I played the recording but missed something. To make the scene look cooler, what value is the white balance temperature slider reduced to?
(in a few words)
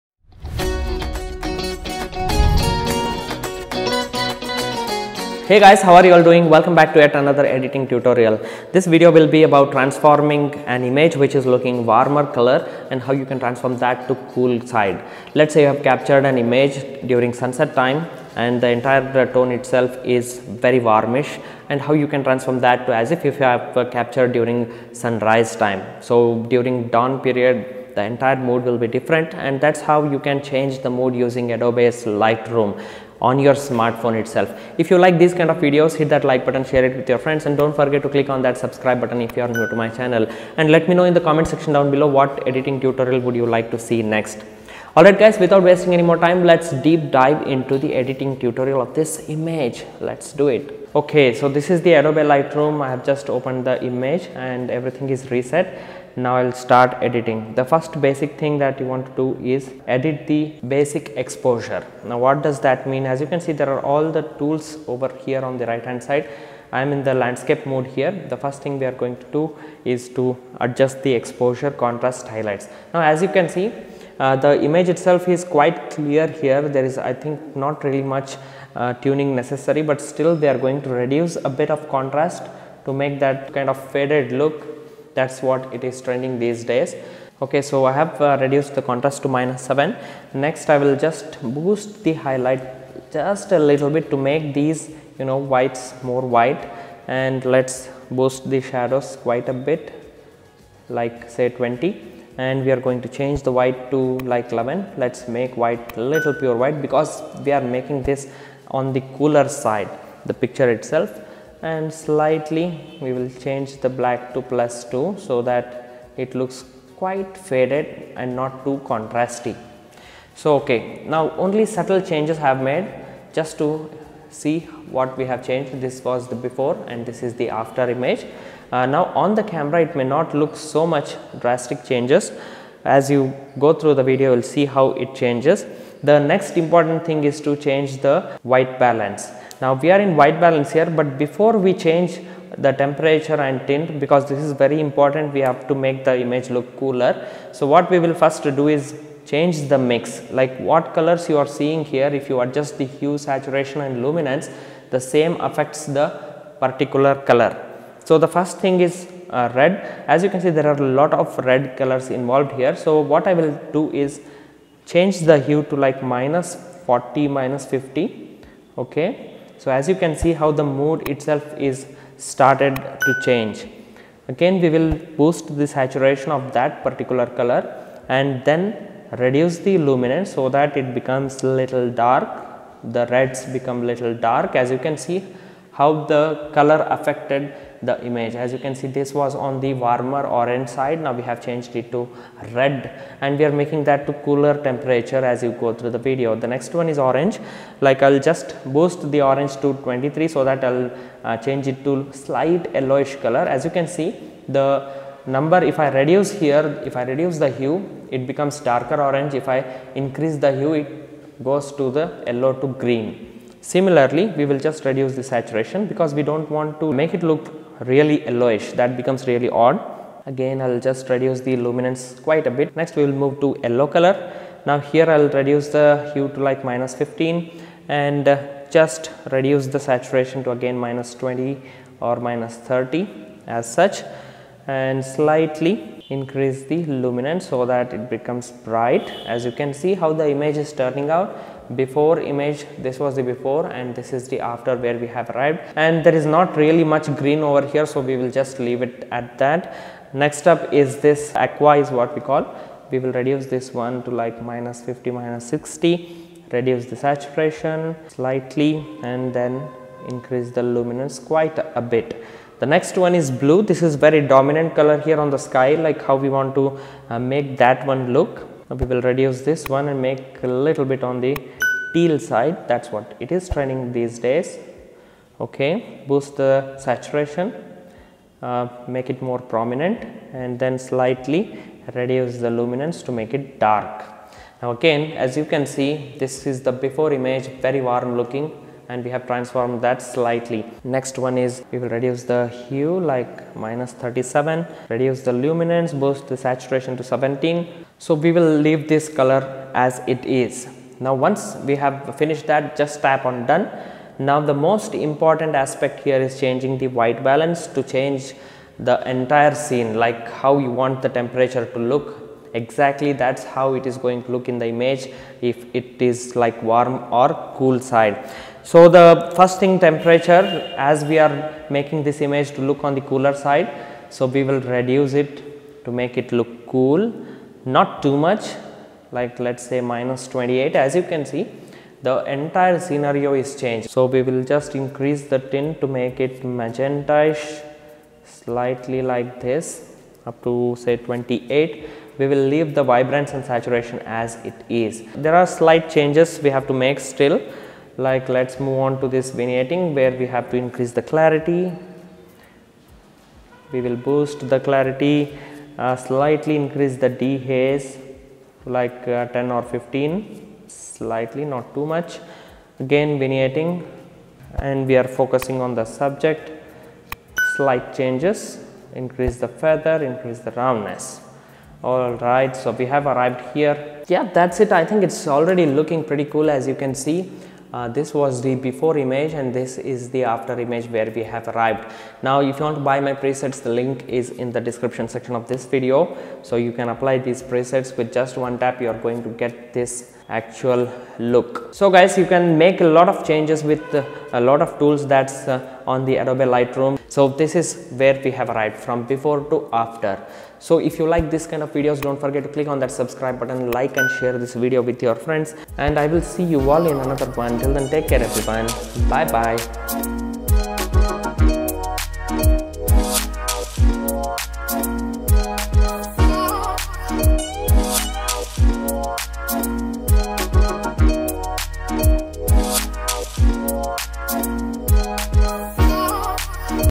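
-28.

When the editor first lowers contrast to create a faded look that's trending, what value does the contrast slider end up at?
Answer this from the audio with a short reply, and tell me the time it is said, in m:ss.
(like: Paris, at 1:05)
-7, at 1:29.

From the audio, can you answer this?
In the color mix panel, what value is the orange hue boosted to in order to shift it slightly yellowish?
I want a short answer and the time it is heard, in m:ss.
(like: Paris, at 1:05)
23, at 3:19.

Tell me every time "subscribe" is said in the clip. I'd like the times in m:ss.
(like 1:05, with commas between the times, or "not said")
0:38, 6:42.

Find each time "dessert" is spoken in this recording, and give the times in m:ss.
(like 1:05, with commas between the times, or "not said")
not said.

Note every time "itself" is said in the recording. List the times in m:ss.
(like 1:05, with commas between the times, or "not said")
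0:19, 0:34, 1:14, 1:50, 2:51.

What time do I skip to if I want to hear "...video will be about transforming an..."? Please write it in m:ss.
0:08.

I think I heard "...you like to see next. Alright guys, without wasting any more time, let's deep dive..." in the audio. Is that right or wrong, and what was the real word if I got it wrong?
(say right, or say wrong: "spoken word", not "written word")
right.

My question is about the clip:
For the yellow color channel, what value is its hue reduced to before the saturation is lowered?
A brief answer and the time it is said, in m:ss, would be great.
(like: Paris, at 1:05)
-15, at 3:46.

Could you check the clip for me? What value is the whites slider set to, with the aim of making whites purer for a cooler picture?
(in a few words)
11.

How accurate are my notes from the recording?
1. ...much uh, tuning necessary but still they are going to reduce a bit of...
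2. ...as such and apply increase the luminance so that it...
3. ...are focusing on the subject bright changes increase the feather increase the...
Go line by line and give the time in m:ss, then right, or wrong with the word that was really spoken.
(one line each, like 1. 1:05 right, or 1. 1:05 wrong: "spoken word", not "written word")
1. 1:18 right
2. 3:53 wrong: "slightly", not "apply"
3. 6:04 wrong: "slight", not "bright".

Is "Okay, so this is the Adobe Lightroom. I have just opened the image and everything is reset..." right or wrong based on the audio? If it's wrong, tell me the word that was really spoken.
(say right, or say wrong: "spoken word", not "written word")
right.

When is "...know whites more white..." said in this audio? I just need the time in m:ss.
1:35.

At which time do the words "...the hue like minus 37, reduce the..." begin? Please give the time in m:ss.
4:52.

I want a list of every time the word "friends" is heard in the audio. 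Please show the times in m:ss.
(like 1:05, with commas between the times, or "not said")
0:37, 6:45.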